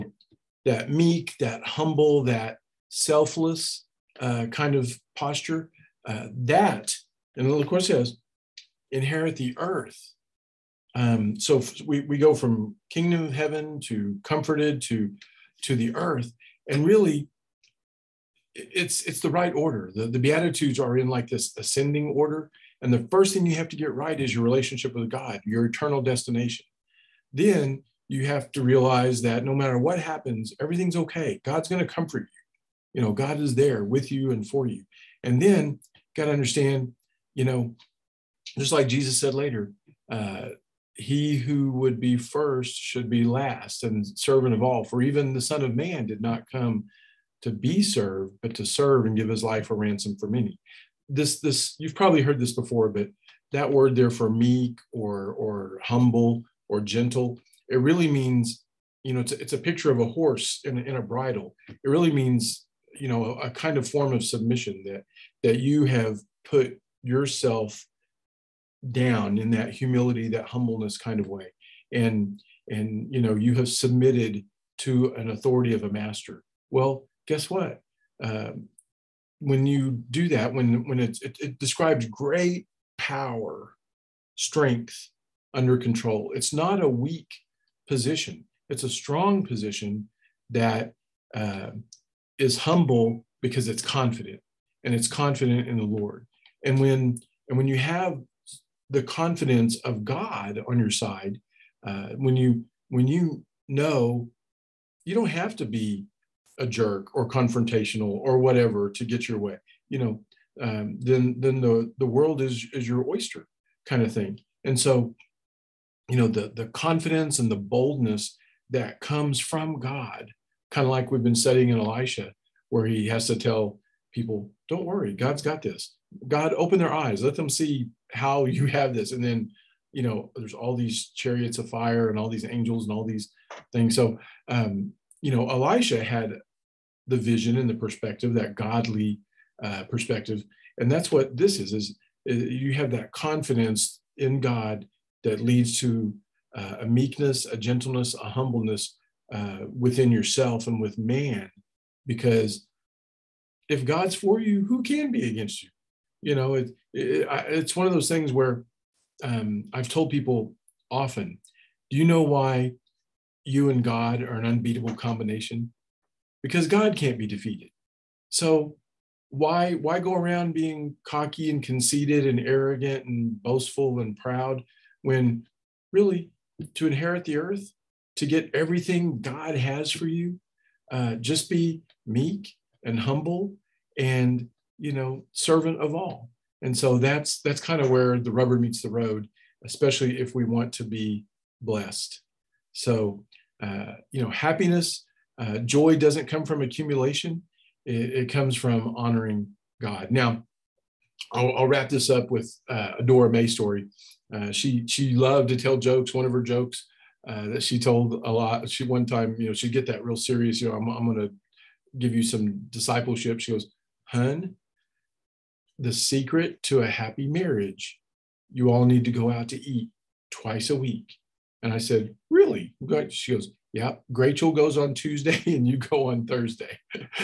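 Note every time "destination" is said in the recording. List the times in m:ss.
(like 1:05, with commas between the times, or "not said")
0:26.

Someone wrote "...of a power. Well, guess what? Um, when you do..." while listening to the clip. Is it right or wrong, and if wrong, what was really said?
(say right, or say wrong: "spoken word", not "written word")
wrong: "master", not "power".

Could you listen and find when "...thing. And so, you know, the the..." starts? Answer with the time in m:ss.
1:54.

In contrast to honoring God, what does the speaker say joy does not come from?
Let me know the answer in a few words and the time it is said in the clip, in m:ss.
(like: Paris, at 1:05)
Accumulation, at 3:16.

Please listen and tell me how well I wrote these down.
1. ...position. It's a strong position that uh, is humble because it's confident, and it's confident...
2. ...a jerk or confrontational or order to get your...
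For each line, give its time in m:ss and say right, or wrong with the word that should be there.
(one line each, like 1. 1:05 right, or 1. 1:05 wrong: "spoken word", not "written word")
1. 1:27 right
2. 1:46 wrong: "whatever", not "order".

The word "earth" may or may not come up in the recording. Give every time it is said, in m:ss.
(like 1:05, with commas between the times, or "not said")
0:09, 0:15, 2:57.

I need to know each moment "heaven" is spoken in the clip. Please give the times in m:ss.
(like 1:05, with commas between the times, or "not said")
0:13.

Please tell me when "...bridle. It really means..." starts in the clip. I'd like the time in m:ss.
1:01.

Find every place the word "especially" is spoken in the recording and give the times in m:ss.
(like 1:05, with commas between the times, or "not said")
3:09.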